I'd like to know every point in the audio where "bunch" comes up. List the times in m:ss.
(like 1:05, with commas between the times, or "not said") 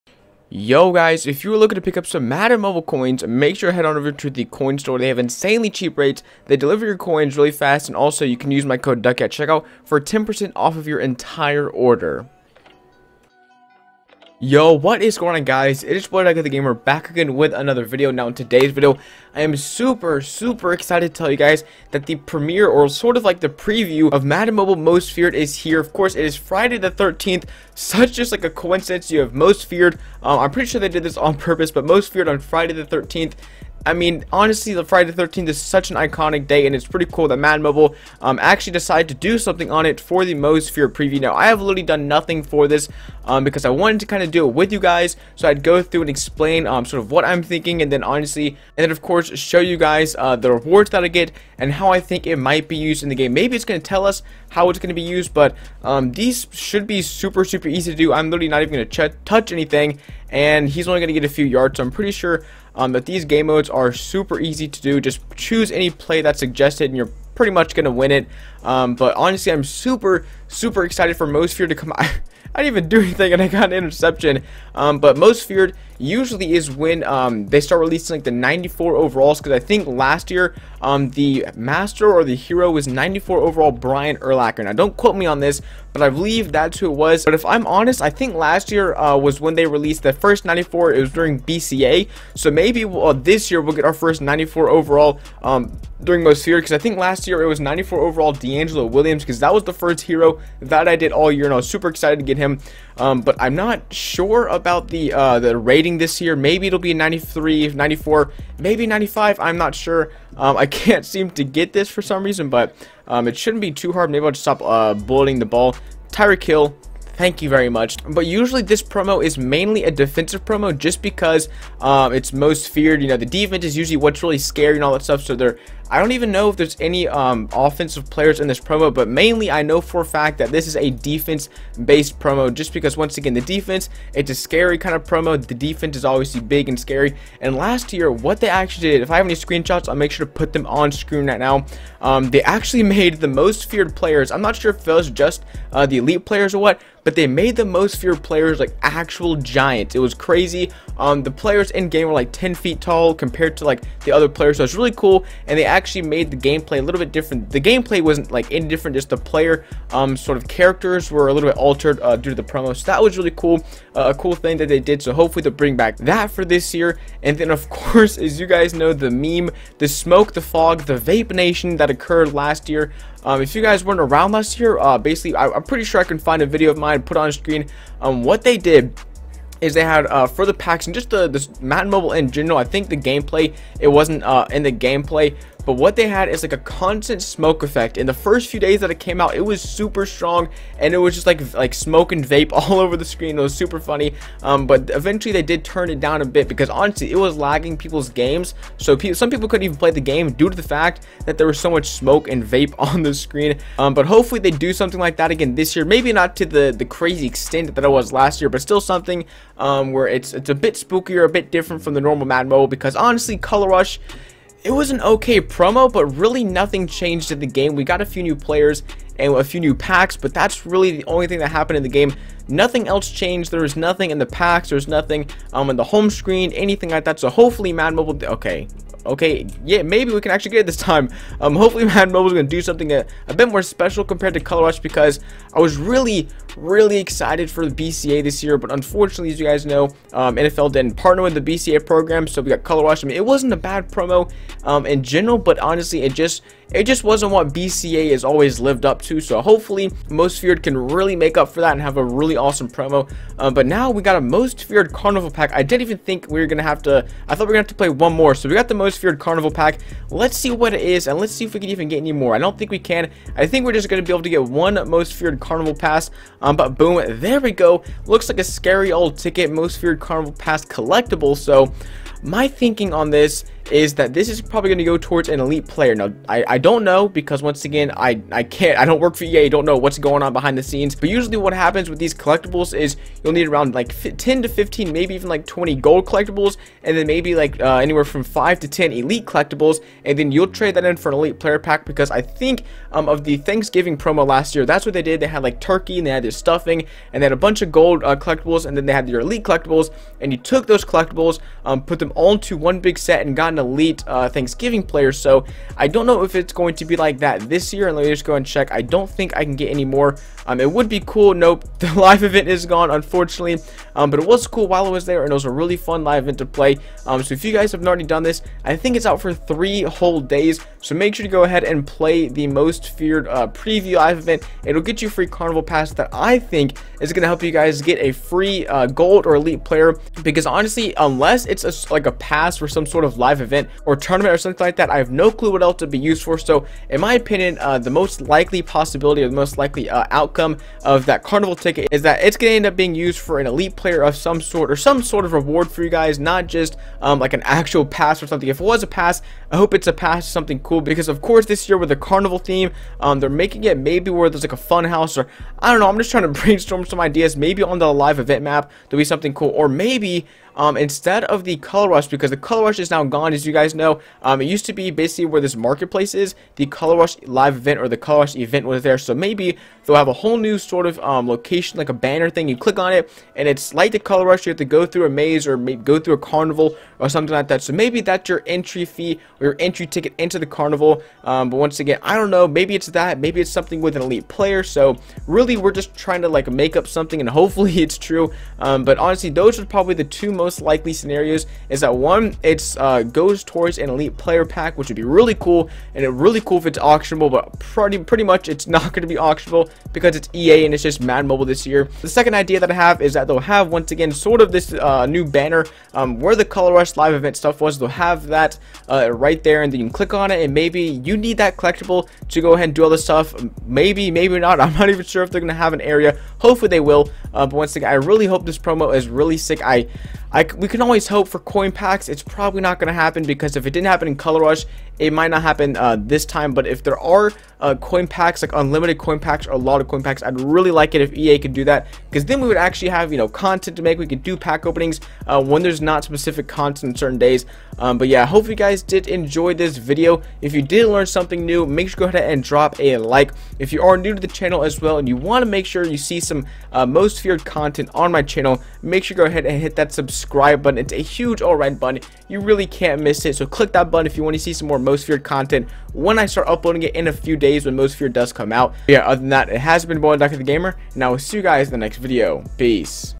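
4:57.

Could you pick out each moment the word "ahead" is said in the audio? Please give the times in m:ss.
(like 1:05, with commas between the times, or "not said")
5:21, 6:52, 7:22, 7:29.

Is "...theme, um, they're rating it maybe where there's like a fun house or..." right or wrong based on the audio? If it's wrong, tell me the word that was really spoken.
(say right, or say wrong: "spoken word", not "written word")
wrong: "making", not "rating".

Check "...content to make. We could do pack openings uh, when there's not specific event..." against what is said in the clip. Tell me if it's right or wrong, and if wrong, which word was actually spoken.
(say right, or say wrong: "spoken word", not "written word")
wrong: "content", not "event".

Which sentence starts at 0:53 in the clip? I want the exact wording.
Maybe it's going to tell us how it's going to be used, but um, these should be super, super easy to do.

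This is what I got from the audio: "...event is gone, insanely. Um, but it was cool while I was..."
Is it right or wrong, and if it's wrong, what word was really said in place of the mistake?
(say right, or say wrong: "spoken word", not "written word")
wrong: "unfortunately", not "insanely".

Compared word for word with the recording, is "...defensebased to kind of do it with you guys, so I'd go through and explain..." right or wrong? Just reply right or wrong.
wrong.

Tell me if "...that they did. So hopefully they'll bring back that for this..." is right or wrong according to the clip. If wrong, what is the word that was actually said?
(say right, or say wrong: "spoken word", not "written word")
right.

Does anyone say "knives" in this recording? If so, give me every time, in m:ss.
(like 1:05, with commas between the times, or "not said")
not said.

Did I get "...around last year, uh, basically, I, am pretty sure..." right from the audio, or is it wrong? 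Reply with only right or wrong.
right.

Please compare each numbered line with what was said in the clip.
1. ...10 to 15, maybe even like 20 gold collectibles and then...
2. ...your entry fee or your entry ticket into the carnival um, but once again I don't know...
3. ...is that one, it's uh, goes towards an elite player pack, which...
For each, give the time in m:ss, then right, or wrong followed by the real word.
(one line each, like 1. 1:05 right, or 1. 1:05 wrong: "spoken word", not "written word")
1. 4:44 right
2. 6:18 right
3. 6:31 right.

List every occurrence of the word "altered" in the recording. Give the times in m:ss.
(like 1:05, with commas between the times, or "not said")
2:41.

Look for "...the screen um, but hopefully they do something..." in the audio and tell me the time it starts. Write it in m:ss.
3:23.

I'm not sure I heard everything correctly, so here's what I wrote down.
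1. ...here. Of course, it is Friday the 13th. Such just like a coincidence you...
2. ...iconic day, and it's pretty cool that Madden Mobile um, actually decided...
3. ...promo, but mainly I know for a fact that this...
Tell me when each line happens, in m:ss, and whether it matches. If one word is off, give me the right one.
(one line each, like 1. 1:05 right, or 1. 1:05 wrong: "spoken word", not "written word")
1. 0:25 right
2. 0:35 right
3. 2:08 right.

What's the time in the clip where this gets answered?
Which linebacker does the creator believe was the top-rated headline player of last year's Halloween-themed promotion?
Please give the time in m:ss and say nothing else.
1:23.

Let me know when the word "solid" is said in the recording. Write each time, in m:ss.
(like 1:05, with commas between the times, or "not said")
not said.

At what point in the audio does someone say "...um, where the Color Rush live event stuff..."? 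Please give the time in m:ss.
6:45.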